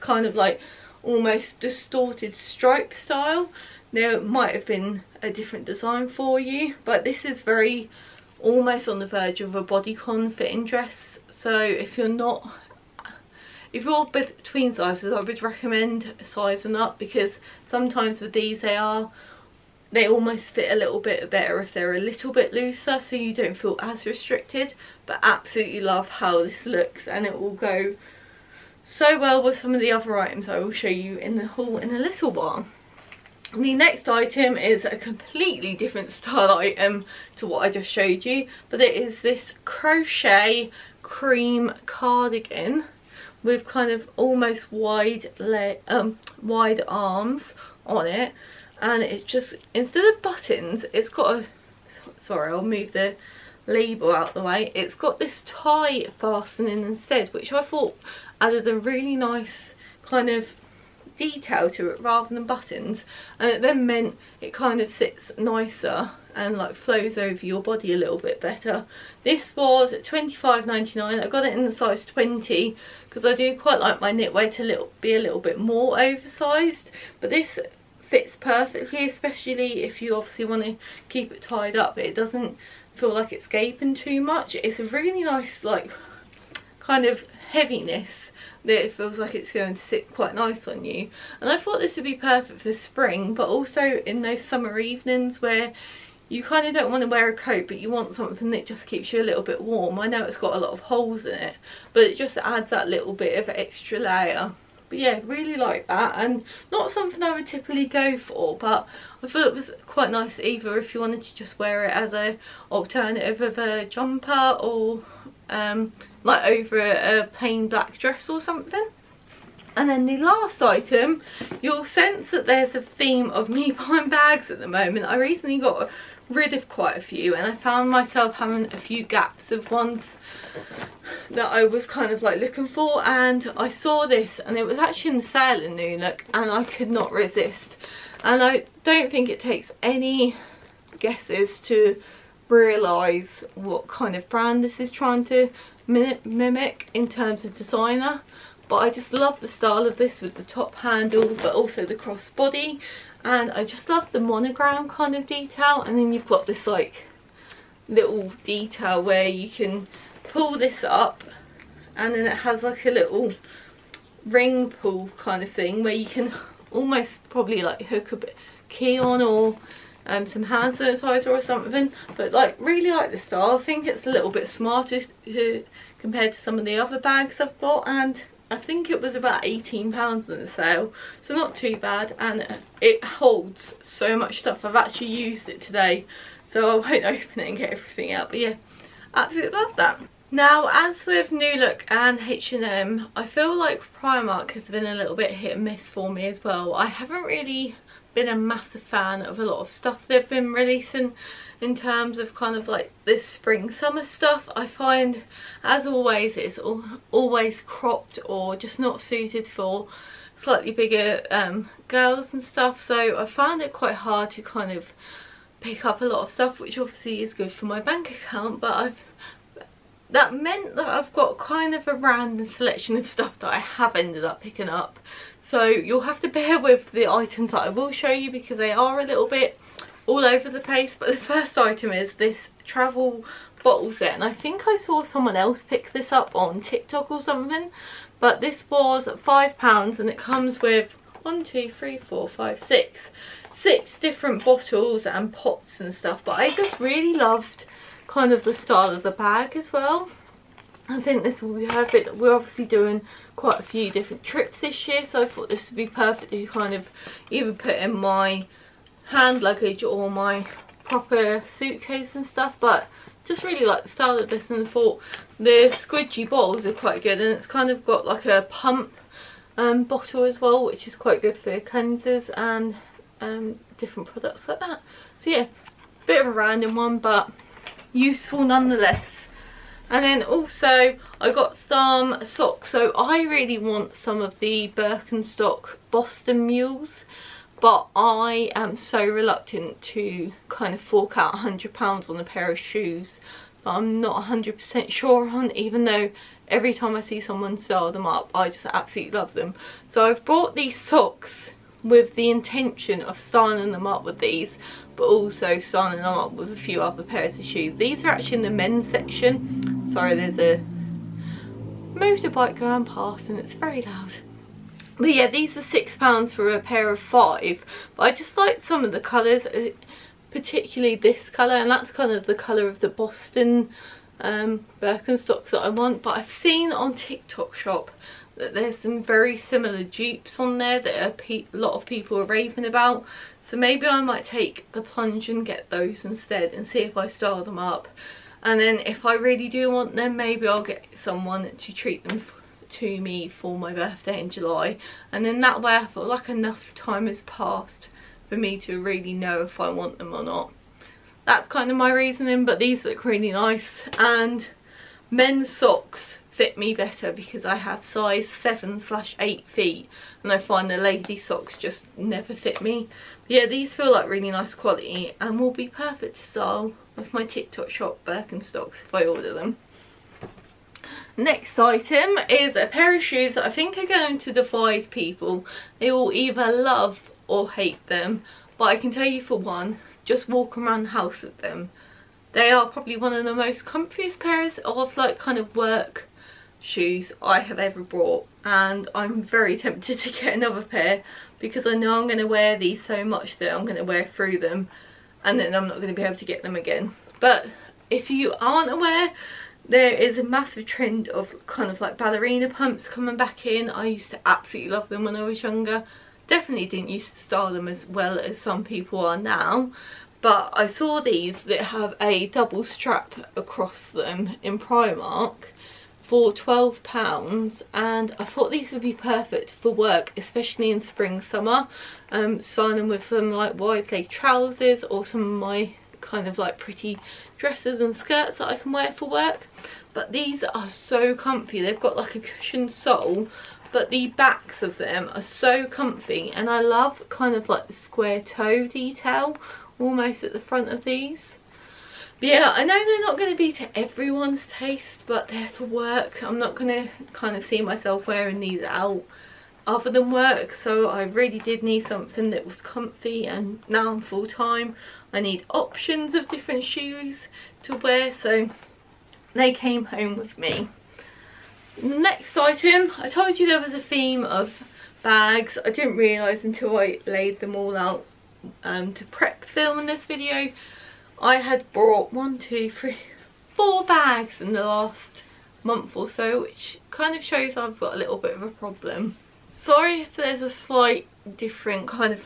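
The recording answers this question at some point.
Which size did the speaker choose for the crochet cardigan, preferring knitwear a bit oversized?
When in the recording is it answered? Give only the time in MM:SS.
01:11.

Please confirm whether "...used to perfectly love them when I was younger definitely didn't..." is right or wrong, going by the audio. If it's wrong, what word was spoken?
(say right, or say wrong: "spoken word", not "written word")
wrong: "absolutely", not "perfectly".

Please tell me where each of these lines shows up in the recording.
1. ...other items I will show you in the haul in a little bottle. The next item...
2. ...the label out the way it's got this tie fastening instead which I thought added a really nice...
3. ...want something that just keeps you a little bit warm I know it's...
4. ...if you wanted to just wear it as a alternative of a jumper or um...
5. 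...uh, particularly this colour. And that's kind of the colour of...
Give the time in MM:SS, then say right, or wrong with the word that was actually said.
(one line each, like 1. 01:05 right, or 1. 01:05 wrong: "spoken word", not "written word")
1. 00:29 wrong: "while", not "bottle"
2. 00:52 right
3. 01:37 right
4. 01:50 right
5. 05:19 right.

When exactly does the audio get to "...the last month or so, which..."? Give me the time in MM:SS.
07:54.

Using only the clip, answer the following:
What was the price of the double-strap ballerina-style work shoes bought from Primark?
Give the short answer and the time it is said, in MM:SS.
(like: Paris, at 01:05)
£12, at 06:56.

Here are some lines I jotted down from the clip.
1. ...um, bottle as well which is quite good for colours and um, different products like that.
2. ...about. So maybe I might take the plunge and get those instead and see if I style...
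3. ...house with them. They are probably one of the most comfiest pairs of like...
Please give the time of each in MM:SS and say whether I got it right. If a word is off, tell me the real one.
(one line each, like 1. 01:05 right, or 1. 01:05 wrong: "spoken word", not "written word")
1. 04:29 wrong: "cleansers", not "colours"
2. 05:32 right
3. 06:20 right.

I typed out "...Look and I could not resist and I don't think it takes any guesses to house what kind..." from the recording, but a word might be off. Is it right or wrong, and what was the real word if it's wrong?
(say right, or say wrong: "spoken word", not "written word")
wrong: "realise", not "house".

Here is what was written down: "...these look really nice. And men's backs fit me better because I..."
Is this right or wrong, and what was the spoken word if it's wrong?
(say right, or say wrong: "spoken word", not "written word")
wrong: "socks", not "backs".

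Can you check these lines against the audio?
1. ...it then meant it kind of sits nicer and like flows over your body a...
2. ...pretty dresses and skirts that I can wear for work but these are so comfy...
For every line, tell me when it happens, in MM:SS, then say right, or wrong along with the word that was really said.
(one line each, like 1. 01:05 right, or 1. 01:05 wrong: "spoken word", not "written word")
1. 01:03 right
2. 07:06 right.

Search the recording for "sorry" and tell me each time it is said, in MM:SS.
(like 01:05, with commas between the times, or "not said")
00:52, 05:09, 07:59.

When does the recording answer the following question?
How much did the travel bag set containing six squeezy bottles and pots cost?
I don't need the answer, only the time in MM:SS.
03:59.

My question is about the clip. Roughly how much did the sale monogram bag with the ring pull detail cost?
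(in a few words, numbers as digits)
£18.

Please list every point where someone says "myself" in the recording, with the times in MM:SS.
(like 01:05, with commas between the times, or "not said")
02:07, 07:27.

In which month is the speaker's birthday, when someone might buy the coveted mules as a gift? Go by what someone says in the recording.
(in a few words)
July.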